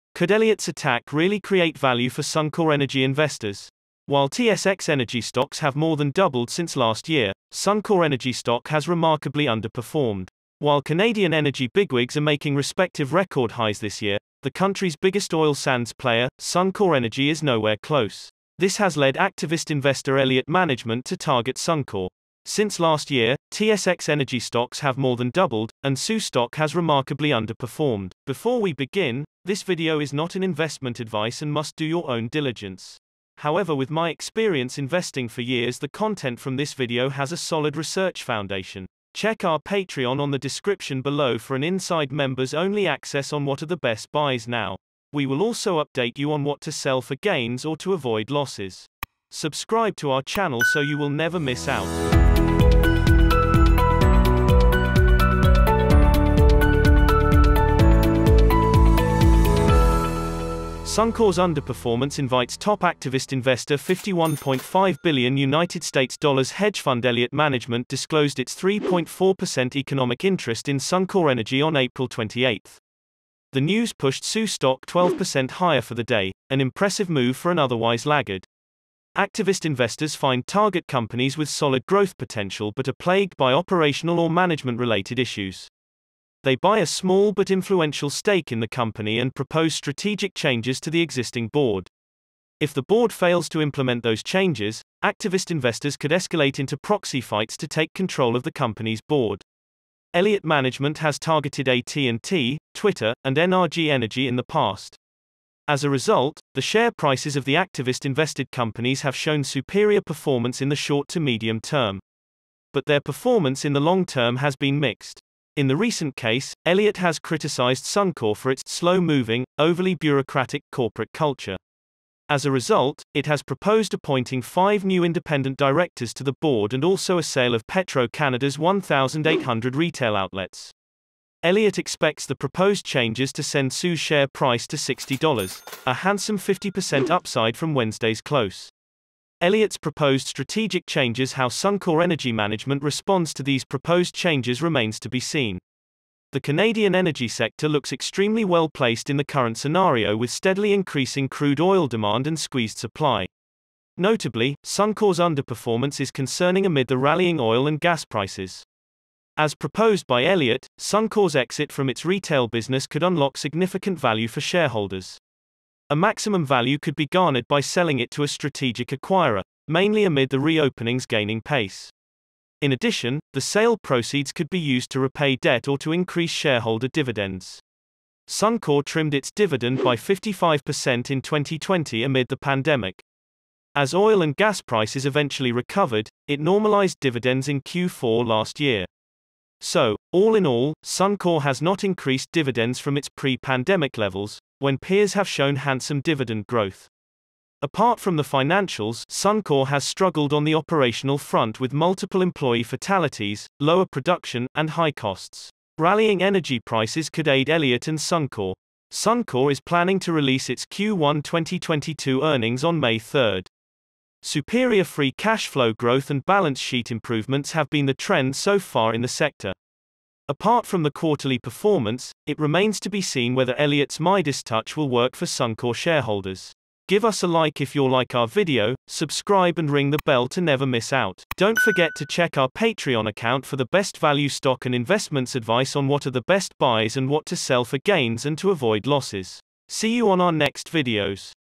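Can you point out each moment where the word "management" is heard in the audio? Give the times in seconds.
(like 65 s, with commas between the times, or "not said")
20 s, 67 s, 84 s, 100 s, 142 s.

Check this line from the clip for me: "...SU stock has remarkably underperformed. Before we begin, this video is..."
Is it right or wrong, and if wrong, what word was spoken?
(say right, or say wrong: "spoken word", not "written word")
right.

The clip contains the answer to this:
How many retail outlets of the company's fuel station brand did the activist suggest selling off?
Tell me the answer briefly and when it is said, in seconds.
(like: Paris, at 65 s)
1,800, at 128 s.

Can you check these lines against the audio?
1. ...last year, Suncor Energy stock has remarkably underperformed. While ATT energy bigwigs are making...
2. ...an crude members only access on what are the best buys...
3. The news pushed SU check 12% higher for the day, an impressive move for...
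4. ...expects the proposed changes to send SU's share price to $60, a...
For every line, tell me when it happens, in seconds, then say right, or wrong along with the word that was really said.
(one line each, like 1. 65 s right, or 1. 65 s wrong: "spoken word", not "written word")
1. 6 s wrong: "Canadian", not "ATT"
2. 41 s wrong: "inside", not "crude"
3. 73 s wrong: "stock", not "check"
4. 131 s right.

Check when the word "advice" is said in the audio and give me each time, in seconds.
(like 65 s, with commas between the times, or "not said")
30 s, 235 s.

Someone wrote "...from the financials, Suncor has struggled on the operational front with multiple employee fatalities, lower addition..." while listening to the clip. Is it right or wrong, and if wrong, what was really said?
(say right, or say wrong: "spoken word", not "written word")
wrong: "production", not "addition".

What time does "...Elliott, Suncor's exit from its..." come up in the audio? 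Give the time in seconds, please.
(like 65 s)
160 s.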